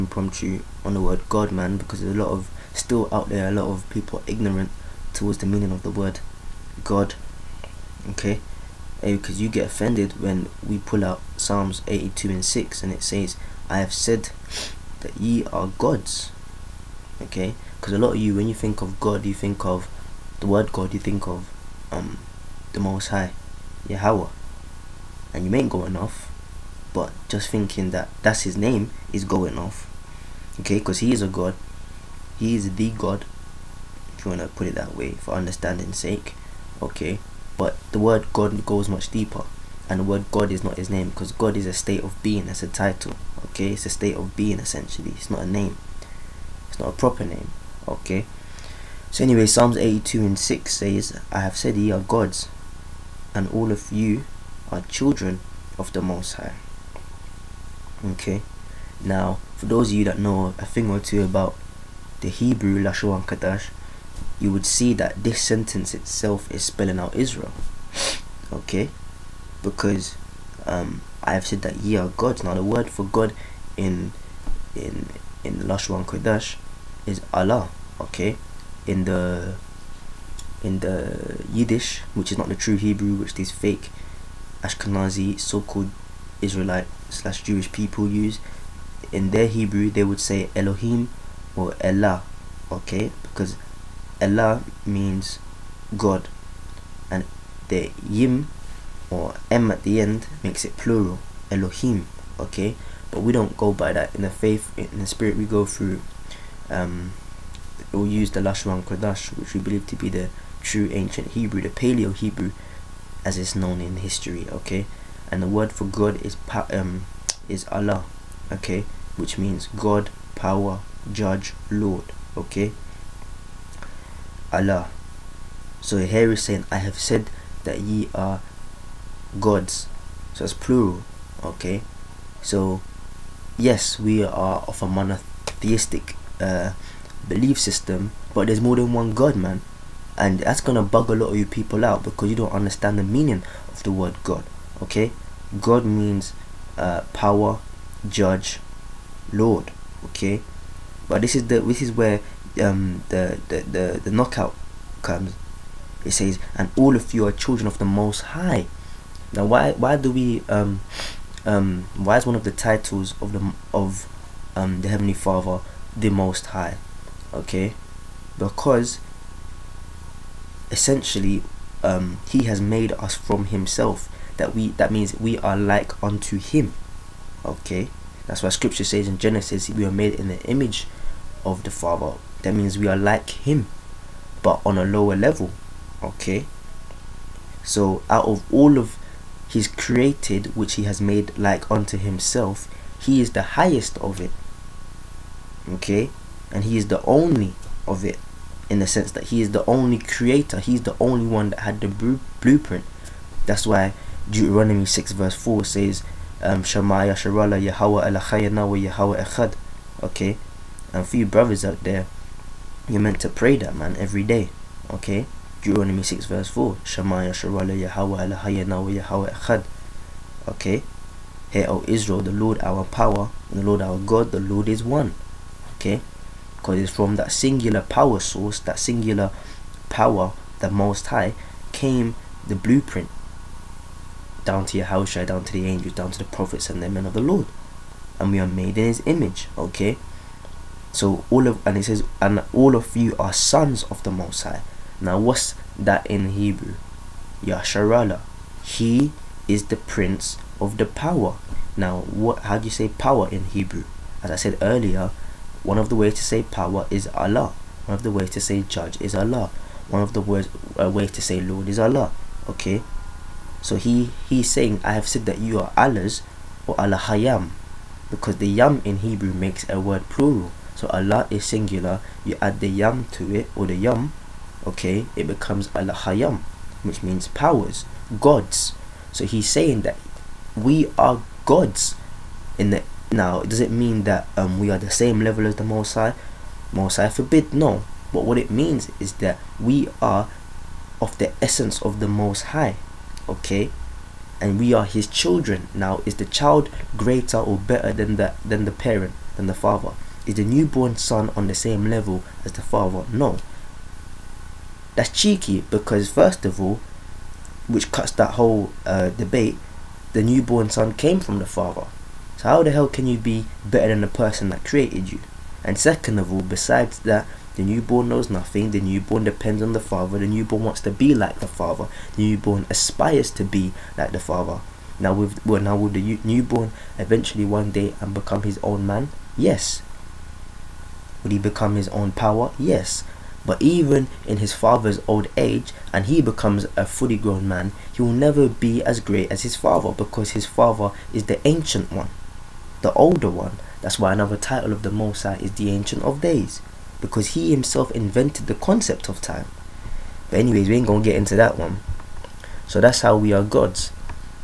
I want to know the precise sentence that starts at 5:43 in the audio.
That's why another title of the Most High is the Ancient of Days, because he himself invented the concept of time.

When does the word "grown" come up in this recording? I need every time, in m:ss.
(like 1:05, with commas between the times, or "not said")
5:37.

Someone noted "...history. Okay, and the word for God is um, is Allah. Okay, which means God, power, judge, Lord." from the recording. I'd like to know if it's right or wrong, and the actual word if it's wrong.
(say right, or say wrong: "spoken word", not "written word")
right.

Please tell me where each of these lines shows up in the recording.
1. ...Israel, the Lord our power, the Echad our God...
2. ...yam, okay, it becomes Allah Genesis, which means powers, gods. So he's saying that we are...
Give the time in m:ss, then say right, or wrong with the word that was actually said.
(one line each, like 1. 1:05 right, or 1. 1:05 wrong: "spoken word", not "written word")
1. 3:41 wrong: "Lord", not "Echad"
2. 4:33 wrong: "Hayam", not "Genesis".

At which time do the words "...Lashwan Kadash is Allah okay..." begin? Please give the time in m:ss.
1:15.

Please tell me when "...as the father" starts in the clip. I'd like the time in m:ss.
5:02.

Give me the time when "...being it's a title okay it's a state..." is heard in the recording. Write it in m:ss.
0:42.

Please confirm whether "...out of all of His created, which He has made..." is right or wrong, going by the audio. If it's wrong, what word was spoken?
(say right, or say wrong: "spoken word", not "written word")
right.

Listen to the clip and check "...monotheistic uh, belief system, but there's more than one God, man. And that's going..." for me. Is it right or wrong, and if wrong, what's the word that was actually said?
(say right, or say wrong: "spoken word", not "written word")
right.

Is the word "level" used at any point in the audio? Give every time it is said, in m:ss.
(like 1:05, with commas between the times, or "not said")
3:05, 4:45, 5:01.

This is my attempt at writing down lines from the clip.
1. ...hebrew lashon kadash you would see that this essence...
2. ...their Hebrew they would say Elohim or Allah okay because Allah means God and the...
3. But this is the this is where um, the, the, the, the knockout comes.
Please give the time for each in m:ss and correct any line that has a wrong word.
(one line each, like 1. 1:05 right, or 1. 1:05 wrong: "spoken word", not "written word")
1. 1:02 wrong: "sentence", not "essence"
2. 1:29 right
3. 2:31 right.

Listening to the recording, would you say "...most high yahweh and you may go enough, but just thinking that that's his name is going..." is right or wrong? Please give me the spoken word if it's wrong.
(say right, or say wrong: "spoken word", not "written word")
right.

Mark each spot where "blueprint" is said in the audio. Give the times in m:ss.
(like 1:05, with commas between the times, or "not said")
3:21, 3:52.